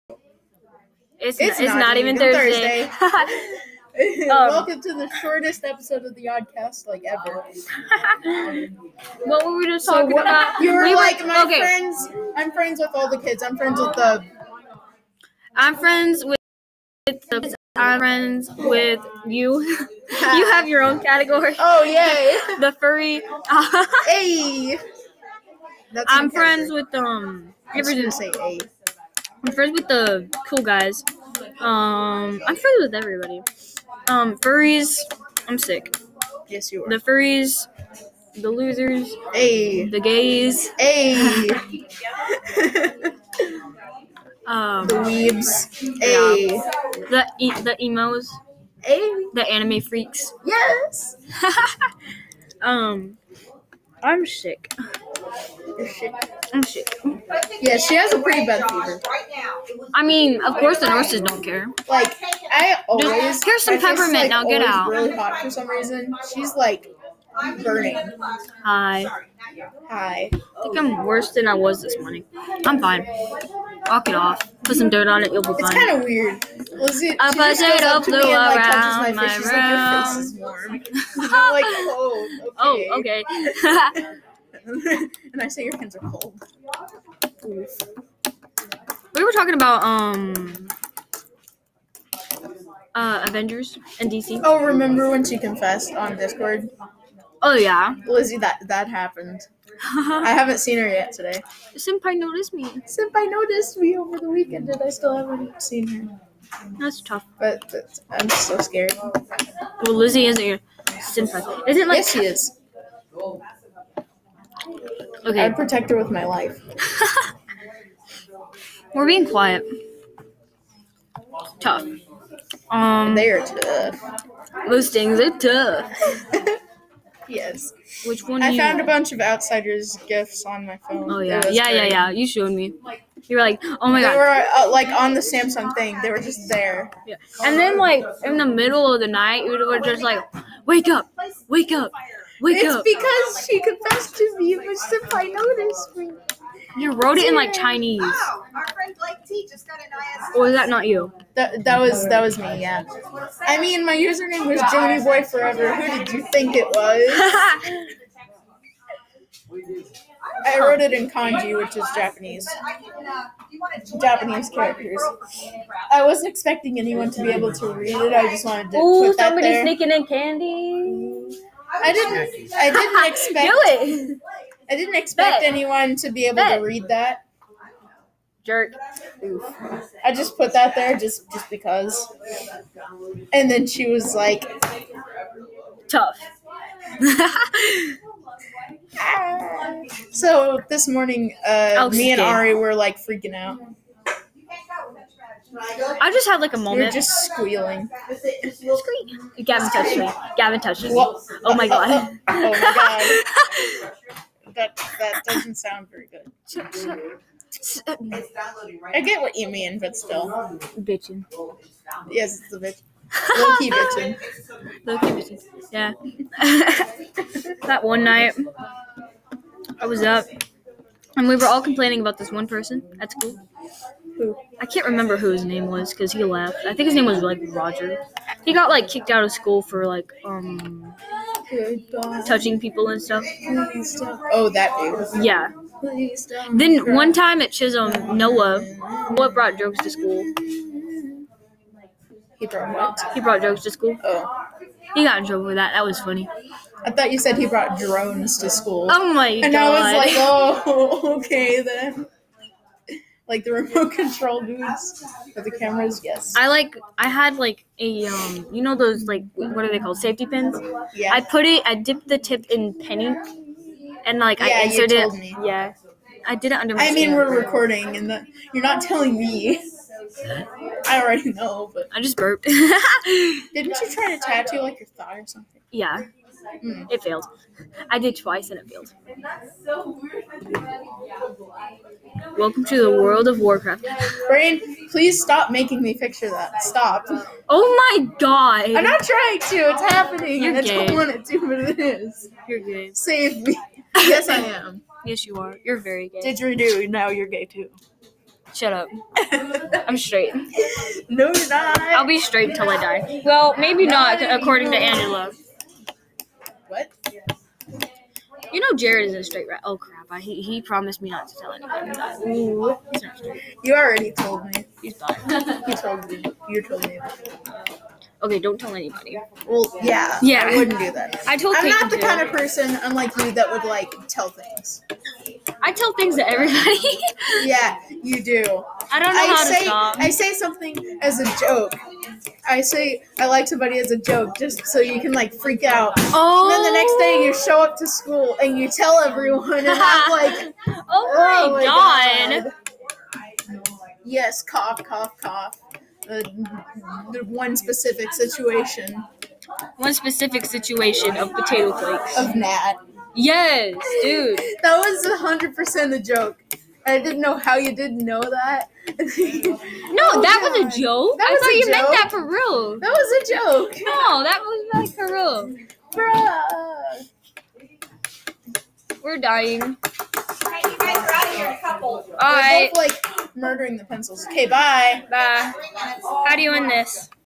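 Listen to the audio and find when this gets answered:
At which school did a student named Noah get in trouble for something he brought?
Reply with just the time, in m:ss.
3:57.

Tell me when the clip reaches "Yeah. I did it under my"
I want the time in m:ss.
4:25.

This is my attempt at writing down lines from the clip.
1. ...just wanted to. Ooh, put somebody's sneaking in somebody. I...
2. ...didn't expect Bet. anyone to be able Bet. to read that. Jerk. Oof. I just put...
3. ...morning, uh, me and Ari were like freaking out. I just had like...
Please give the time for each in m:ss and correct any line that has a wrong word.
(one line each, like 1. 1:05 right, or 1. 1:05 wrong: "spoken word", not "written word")
1. 2:48 wrong: "candy", not "somebody"
2. 2:54 right
3. 3:10 right.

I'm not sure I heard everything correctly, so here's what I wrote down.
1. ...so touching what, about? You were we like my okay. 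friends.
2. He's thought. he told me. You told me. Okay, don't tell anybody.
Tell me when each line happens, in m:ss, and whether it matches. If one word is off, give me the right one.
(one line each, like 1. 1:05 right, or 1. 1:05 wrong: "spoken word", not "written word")
1. 0:09 wrong: "talking", not "touching"
2. 5:14 right.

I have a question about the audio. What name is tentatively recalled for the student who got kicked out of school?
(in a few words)
Roger.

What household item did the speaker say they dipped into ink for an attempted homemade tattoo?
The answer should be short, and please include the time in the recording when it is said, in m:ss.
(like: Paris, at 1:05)
safety pins, at 4:19.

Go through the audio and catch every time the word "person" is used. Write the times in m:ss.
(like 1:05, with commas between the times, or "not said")
3:42, 5:22.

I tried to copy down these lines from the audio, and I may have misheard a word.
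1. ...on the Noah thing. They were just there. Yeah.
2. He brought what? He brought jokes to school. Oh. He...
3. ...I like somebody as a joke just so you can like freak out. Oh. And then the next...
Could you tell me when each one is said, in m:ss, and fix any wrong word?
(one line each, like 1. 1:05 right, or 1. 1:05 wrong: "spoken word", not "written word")
1. 2:14 wrong: "Samsung", not "Noah"
2. 4:02 right
3. 5:33 right.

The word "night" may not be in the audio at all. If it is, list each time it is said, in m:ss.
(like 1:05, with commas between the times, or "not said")
2:19, 3:38.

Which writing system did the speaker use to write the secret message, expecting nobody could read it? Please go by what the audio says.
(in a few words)
kanji.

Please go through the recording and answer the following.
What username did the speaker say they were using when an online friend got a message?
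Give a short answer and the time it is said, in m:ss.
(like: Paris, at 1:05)
Johnny Boy Forever, at 2:34.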